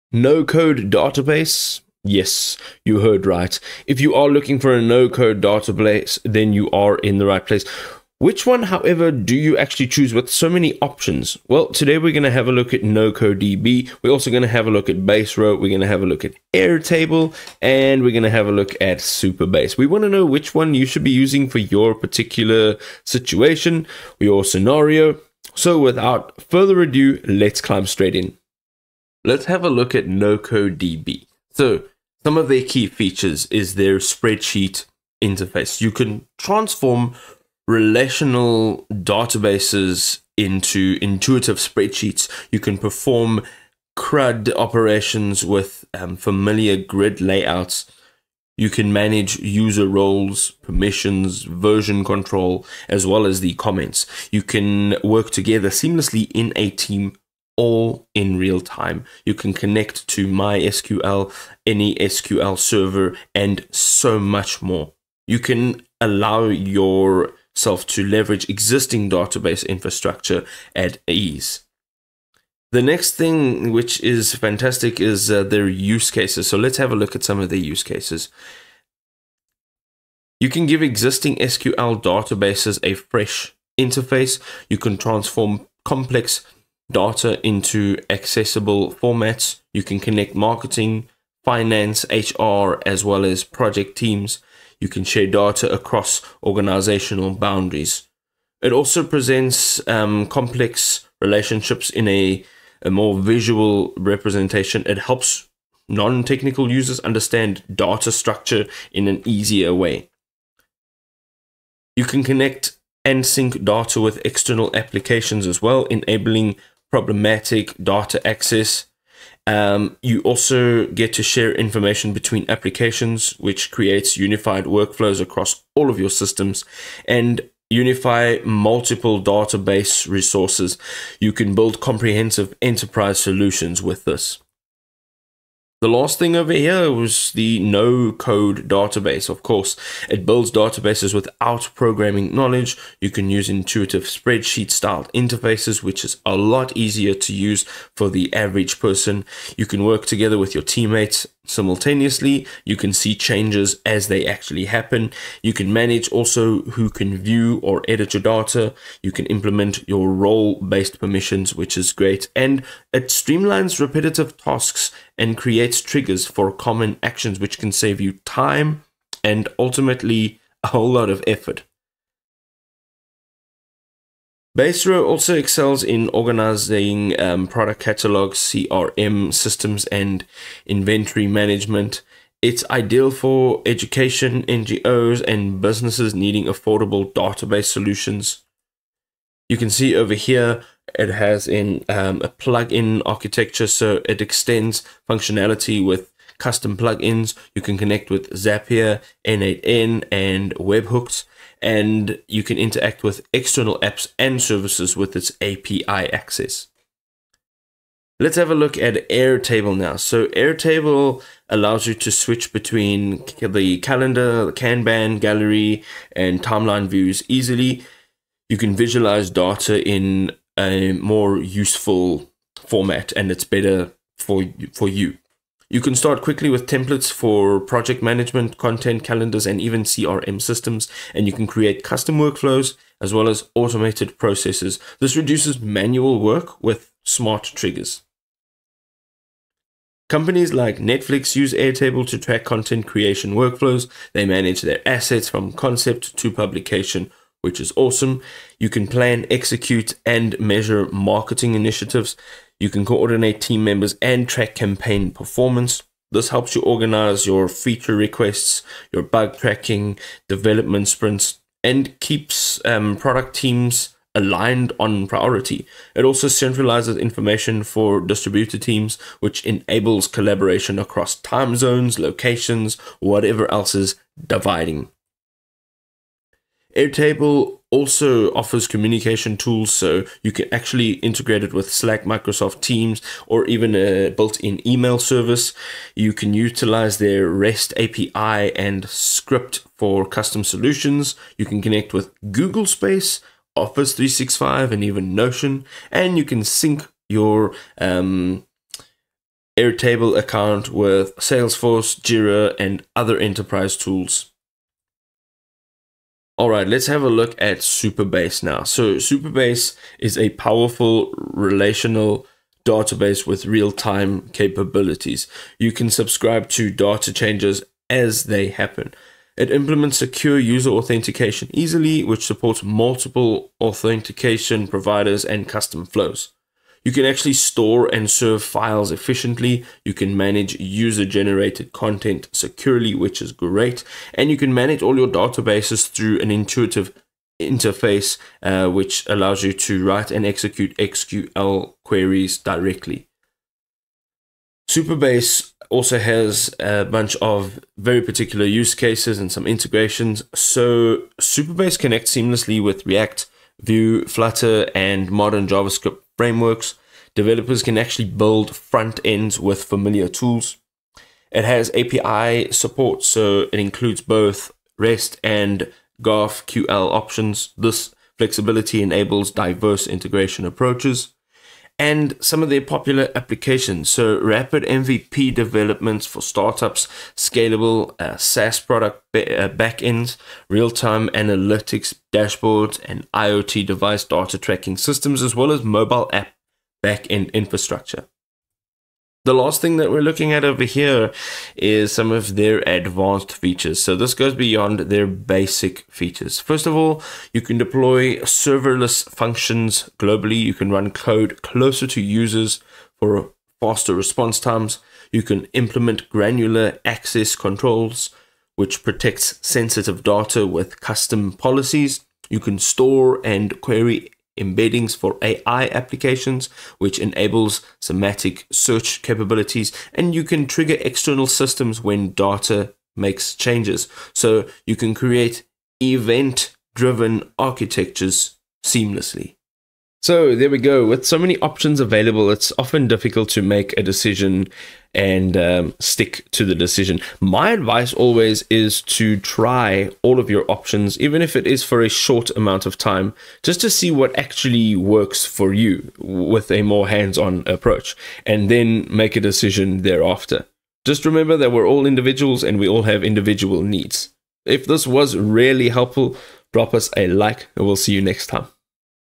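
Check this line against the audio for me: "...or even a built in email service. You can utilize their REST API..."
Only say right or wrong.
right.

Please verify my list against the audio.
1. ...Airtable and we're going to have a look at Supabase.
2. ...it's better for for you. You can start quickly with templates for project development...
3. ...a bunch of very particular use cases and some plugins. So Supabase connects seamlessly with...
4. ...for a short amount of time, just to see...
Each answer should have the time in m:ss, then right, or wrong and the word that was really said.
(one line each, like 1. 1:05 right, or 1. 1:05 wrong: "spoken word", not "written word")
1. 0:16 right
2. 3:43 wrong: "management", not "development"
3. 5:46 wrong: "integrations", not "plugins"
4. 7:21 right.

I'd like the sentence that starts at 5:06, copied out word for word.
All right, let's have a look at Supabase now.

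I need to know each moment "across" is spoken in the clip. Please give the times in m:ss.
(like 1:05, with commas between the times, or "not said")
1:35, 2:05, 4:30.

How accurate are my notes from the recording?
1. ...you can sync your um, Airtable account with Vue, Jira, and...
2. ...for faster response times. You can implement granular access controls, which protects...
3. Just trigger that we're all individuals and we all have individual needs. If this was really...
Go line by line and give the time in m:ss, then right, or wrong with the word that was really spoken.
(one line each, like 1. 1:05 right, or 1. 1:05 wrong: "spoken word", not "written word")
1. 4:56 wrong: "Salesforce", not "Vue"
2. 6:42 right
3. 7:30 wrong: "remember", not "trigger".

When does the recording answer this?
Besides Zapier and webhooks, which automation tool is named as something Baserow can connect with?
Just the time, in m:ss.
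3:19.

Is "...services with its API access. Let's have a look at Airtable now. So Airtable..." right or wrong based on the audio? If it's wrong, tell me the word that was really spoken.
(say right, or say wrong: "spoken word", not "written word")
right.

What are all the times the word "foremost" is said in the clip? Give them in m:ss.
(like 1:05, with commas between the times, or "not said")
not said.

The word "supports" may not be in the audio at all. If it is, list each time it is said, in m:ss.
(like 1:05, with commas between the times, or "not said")
5:22, 6:02.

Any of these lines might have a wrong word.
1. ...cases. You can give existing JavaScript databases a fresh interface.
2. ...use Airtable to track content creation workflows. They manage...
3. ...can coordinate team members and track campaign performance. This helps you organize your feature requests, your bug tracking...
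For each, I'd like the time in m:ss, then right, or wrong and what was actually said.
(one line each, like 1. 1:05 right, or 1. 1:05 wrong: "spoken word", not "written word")
1. 1:17 wrong: "SQL", not "JavaScript"
2. 4:01 right
3. 4:12 right.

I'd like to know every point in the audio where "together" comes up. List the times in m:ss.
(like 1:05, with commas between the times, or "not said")
0:55, 2:30.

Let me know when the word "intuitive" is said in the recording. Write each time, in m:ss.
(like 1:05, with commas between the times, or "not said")
0:41, 2:23, 5:36.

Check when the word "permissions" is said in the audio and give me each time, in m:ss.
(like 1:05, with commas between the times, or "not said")
0:50, 2:40.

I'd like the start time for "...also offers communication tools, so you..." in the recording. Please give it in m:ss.
4:37.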